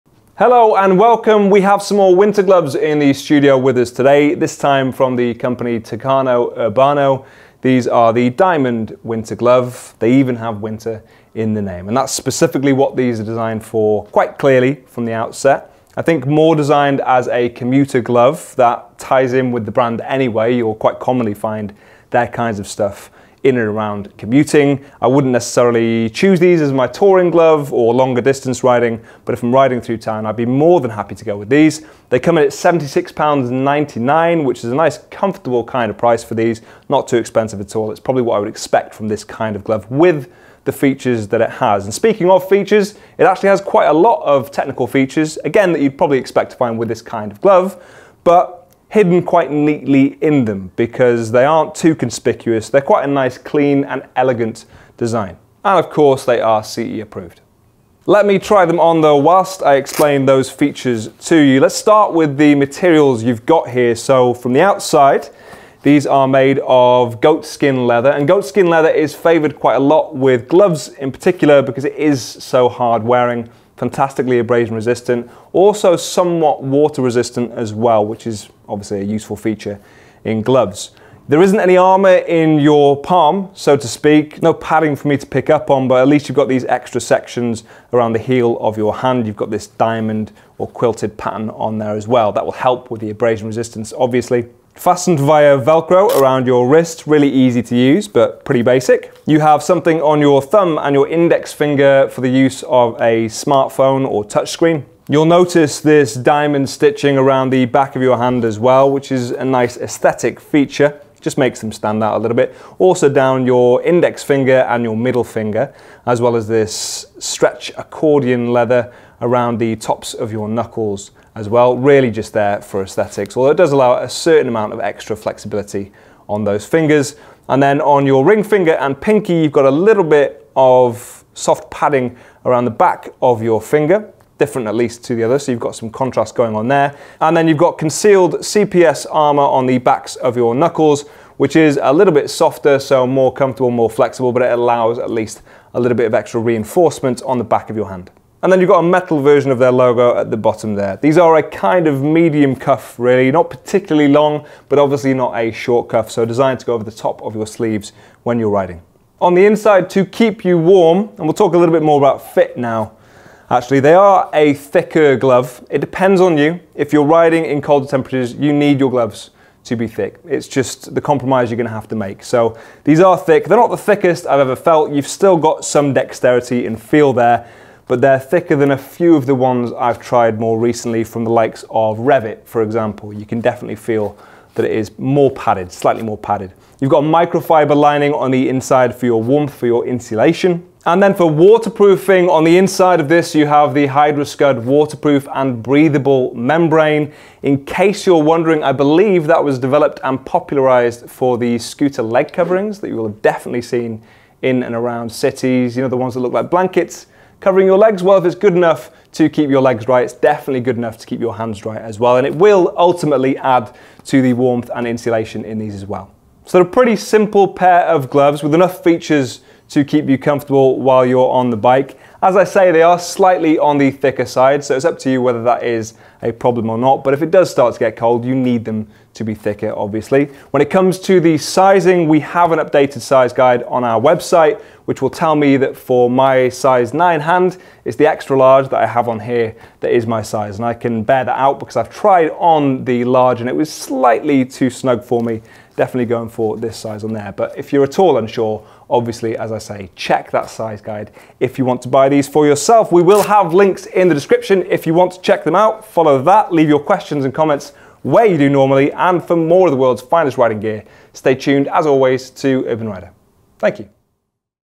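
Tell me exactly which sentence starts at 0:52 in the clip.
They're quite a nice, clean and elegant design.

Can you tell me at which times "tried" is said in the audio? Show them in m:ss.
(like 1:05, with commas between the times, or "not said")
2:59, 4:01.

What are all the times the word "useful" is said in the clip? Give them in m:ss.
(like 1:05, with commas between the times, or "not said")
1:19.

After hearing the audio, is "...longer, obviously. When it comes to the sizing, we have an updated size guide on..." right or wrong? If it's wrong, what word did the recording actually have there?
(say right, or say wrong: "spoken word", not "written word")
wrong: "thicker", not "longer".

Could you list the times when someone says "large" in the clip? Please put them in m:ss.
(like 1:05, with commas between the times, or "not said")
3:58, 4:03.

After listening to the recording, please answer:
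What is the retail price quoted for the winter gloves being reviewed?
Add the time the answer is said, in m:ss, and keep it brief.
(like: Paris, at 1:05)
£76.99, at 0:32.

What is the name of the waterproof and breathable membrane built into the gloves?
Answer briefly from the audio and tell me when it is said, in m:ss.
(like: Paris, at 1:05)
HydroScud, at 3:13.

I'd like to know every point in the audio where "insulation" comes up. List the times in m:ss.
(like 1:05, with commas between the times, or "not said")
3:09, 3:34.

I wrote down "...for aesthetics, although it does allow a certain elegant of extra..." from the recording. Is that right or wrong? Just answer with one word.
wrong.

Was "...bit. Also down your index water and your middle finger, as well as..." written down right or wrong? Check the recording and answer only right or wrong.
wrong.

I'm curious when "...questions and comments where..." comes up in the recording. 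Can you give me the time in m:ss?
4:16.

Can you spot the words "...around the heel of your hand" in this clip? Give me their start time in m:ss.
1:27.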